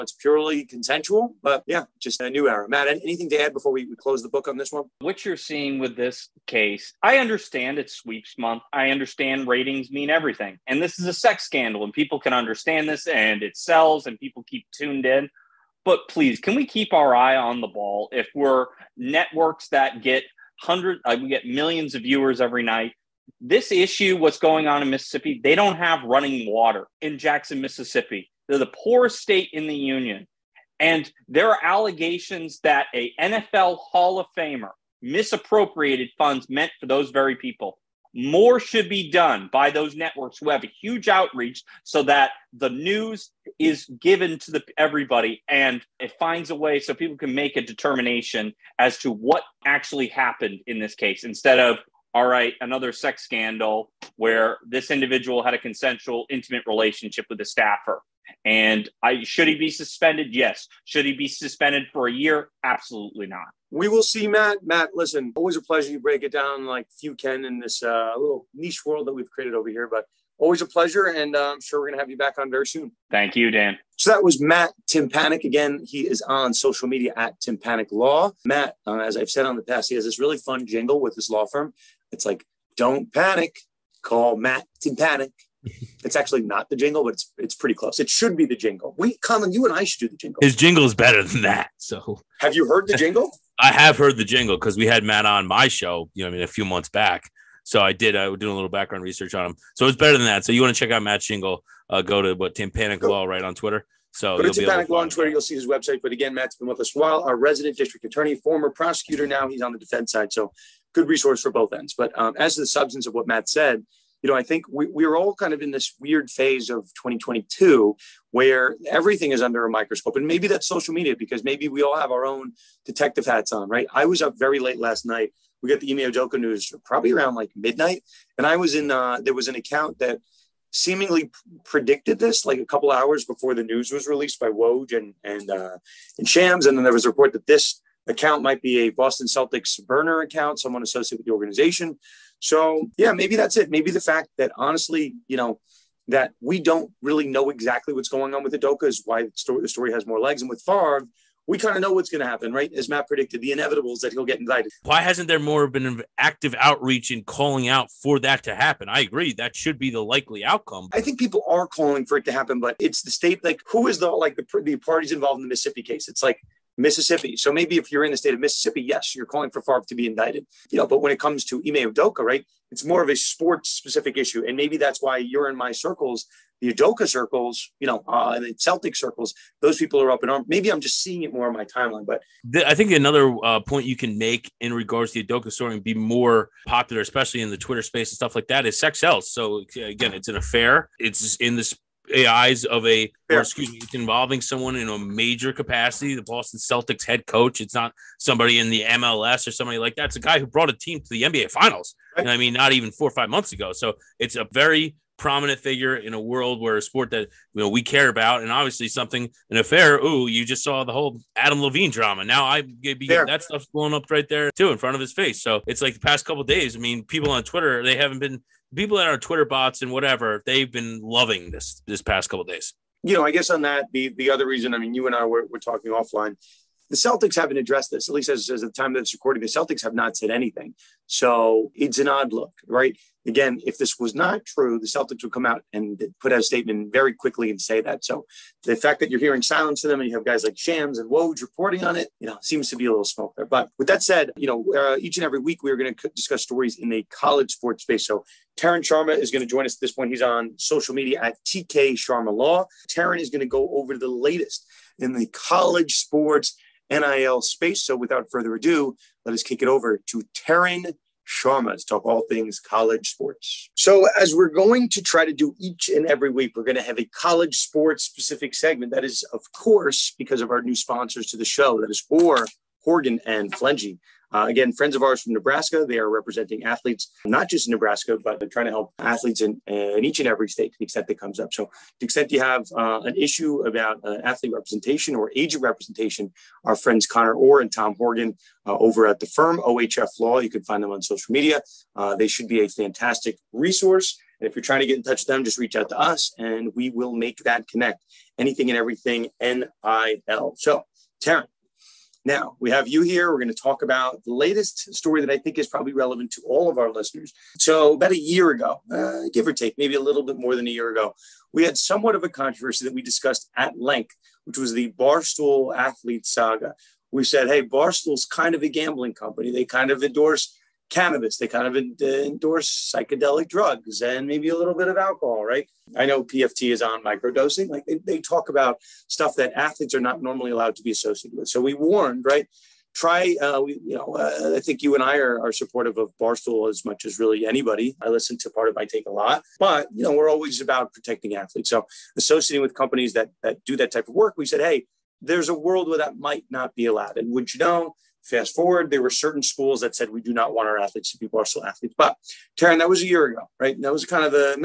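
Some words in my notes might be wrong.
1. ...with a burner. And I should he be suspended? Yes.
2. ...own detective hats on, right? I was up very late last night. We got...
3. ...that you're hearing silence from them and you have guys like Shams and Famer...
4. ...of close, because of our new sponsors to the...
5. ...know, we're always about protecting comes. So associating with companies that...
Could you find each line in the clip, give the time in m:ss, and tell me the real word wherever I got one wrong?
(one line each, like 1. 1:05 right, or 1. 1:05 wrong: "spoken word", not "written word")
1. 0:57 wrong: "staffer", not "burner"
2. 2:02 right
3. 3:59 wrong: "Woj", not "Famer"
4. 4:29 wrong: "course", not "close"
5. 5:40 wrong: "athletes", not "comes".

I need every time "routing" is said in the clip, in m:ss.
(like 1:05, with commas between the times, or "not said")
not said.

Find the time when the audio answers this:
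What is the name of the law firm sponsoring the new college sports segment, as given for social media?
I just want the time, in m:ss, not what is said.
4:49.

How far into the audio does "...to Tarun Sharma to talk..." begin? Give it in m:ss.
4:20.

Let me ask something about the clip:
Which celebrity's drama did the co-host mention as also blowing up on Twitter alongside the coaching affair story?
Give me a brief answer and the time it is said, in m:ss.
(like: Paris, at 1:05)
Adam Levine, at 3:31.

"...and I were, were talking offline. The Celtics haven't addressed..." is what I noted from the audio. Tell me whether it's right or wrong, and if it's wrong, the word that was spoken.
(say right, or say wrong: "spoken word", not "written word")
right.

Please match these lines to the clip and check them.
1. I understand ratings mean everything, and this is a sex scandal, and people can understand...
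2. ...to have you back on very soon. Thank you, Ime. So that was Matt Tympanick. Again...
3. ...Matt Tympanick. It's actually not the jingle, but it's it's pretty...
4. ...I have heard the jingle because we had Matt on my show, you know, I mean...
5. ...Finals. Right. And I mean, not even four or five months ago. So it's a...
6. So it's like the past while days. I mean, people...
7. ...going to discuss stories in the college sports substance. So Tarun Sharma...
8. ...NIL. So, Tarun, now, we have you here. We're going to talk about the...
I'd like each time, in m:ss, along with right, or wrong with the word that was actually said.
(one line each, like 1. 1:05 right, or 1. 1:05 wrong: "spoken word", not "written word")
1. 0:08 right
2. 1:11 wrong: "Dan", not "Ime"
3. 1:24 right
4. 1:33 right
5. 3:21 right
6. 3:35 wrong: "couple", not "while"
7. 4:05 wrong: "space", not "substance"
8. 4:59 right.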